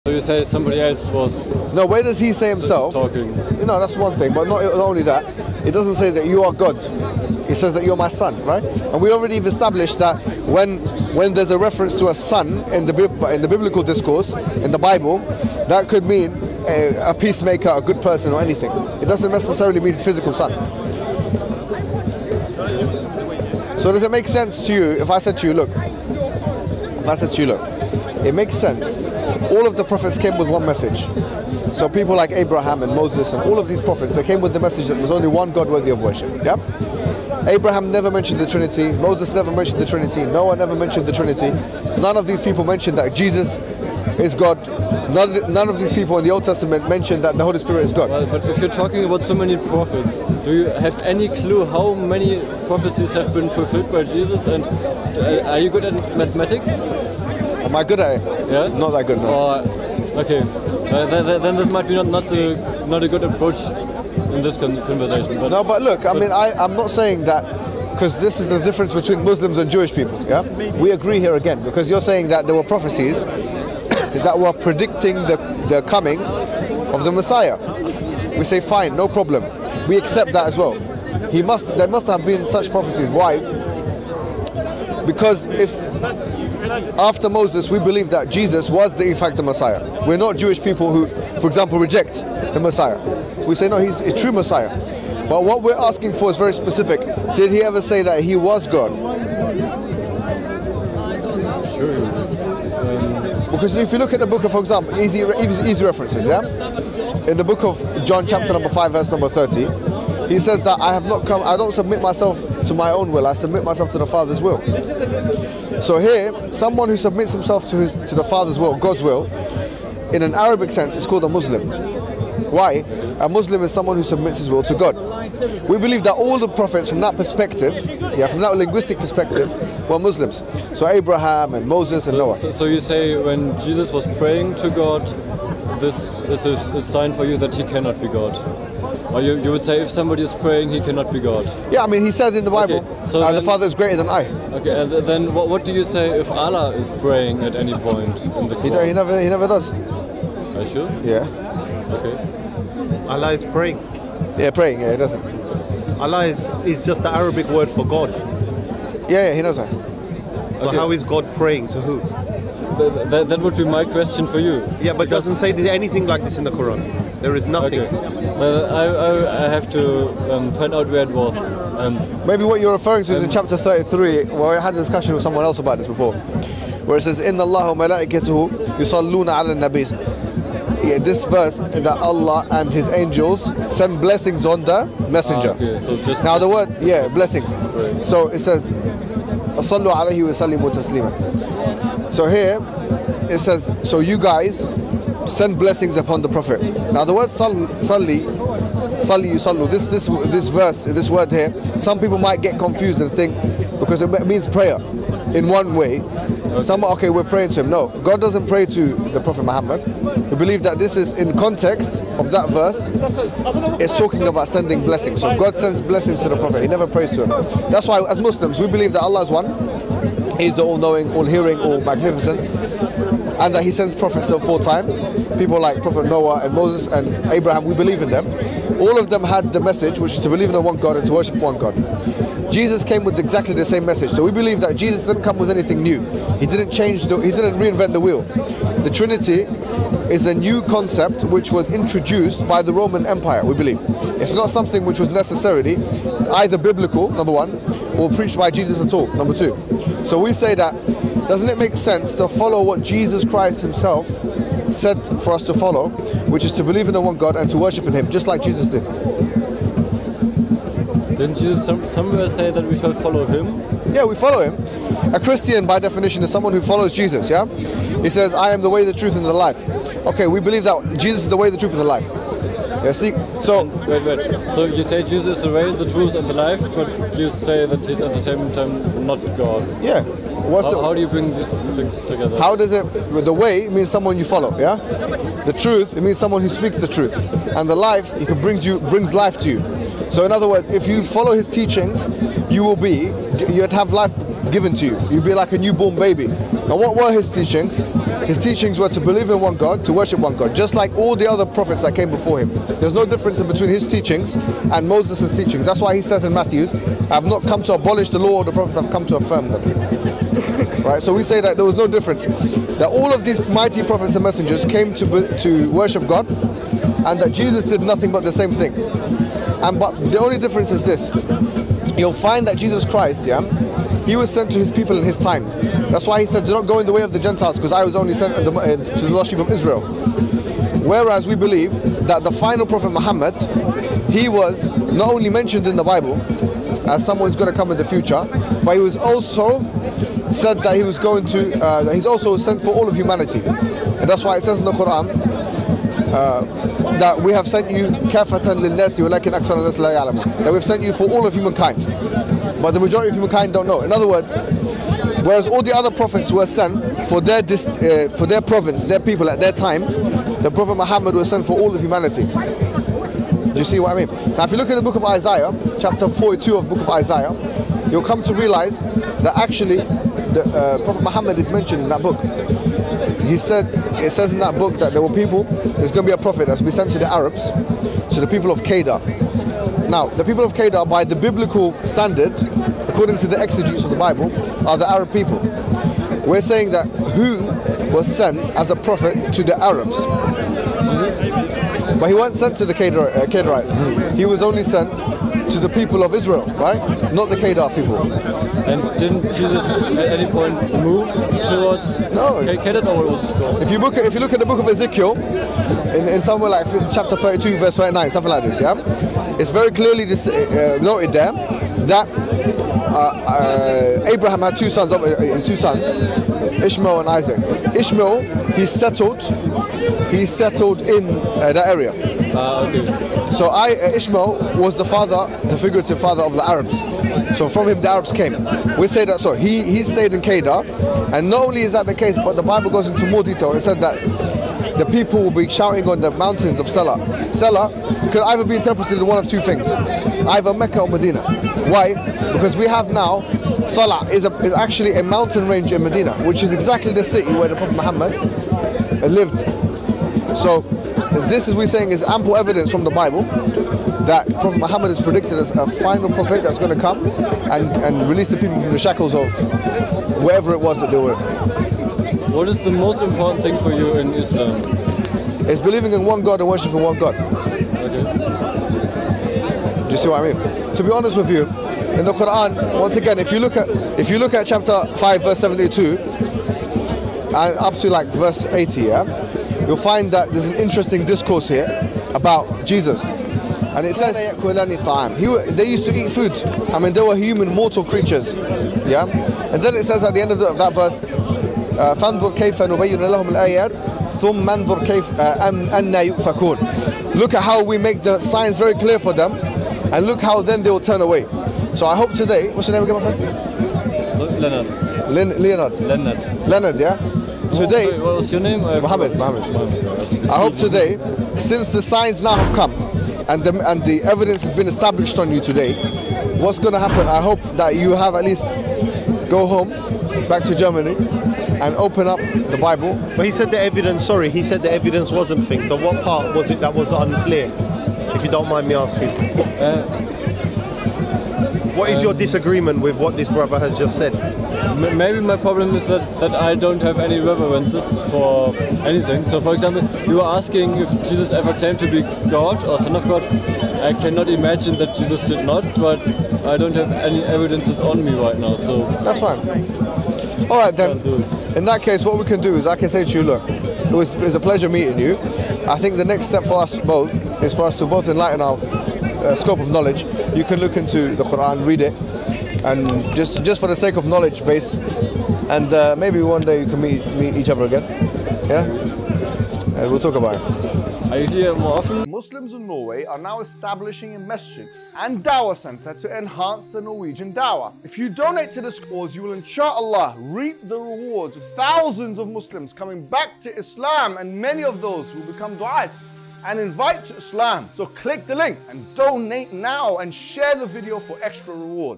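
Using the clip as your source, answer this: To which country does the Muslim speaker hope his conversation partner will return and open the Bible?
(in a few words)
Germany.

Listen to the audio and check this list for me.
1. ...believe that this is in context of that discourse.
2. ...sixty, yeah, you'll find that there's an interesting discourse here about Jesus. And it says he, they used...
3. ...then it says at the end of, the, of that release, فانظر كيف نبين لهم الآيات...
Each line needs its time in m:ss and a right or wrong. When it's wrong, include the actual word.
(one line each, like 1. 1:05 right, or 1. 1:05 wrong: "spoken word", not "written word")
1. 3:30 wrong: "verse", not "discourse"
2. 7:58 wrong: "eighty", not "sixty"
3. 8:09 wrong: "verse", not "release".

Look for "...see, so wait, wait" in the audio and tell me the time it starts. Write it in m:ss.
4:32.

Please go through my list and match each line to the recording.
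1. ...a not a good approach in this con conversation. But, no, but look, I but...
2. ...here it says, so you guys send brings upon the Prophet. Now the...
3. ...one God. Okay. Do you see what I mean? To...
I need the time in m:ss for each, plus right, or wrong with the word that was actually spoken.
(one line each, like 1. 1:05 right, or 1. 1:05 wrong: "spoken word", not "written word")
1. 1:02 right
2. 3:12 wrong: "blessings", not "brings"
3. 7:46 right.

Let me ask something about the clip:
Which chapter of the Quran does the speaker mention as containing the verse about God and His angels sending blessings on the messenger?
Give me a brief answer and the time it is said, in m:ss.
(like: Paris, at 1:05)
Chapter 33, at 2:53.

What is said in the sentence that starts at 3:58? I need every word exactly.
The Trinity is a new concept which was introduced by the Roman Empire, we believe.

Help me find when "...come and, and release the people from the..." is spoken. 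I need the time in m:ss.
7:36.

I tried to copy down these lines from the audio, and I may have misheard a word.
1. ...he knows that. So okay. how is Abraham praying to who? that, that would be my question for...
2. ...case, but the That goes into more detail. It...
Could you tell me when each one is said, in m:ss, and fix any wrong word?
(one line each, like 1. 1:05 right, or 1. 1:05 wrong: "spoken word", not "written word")
1. 2:39 wrong: "God", not "Abraham"
2. 7:11 wrong: "Bible", not "That".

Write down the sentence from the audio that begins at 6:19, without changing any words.
Now, the people of Kedar, by the biblical standard, according to the exegetes of the Bible, are the Arab people.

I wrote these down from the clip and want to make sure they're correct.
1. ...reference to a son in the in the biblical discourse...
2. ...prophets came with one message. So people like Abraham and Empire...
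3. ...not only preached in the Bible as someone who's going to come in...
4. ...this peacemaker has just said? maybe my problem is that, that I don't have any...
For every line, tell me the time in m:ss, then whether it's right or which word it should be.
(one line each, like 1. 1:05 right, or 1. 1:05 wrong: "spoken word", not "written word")
1. 0:11 right
2. 0:29 wrong: "Moses", not "Empire"
3. 5:34 wrong: "mentioned", not "preached"
4. 8:53 wrong: "brother", not "peacemaker".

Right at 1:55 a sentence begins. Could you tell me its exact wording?
So here, someone who submits himself to, his, to the Father's will, God's will, in an Arabic sense, it's called a Muslim.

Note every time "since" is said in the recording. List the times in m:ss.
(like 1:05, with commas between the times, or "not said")
8:31.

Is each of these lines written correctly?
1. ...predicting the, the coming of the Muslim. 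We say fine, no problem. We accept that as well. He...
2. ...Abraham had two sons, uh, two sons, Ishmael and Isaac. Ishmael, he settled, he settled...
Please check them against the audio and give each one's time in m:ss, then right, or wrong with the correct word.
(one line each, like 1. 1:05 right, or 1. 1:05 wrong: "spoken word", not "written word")
1. 1:14 wrong: "Messiah", not "Muslim"
2. 6:54 right.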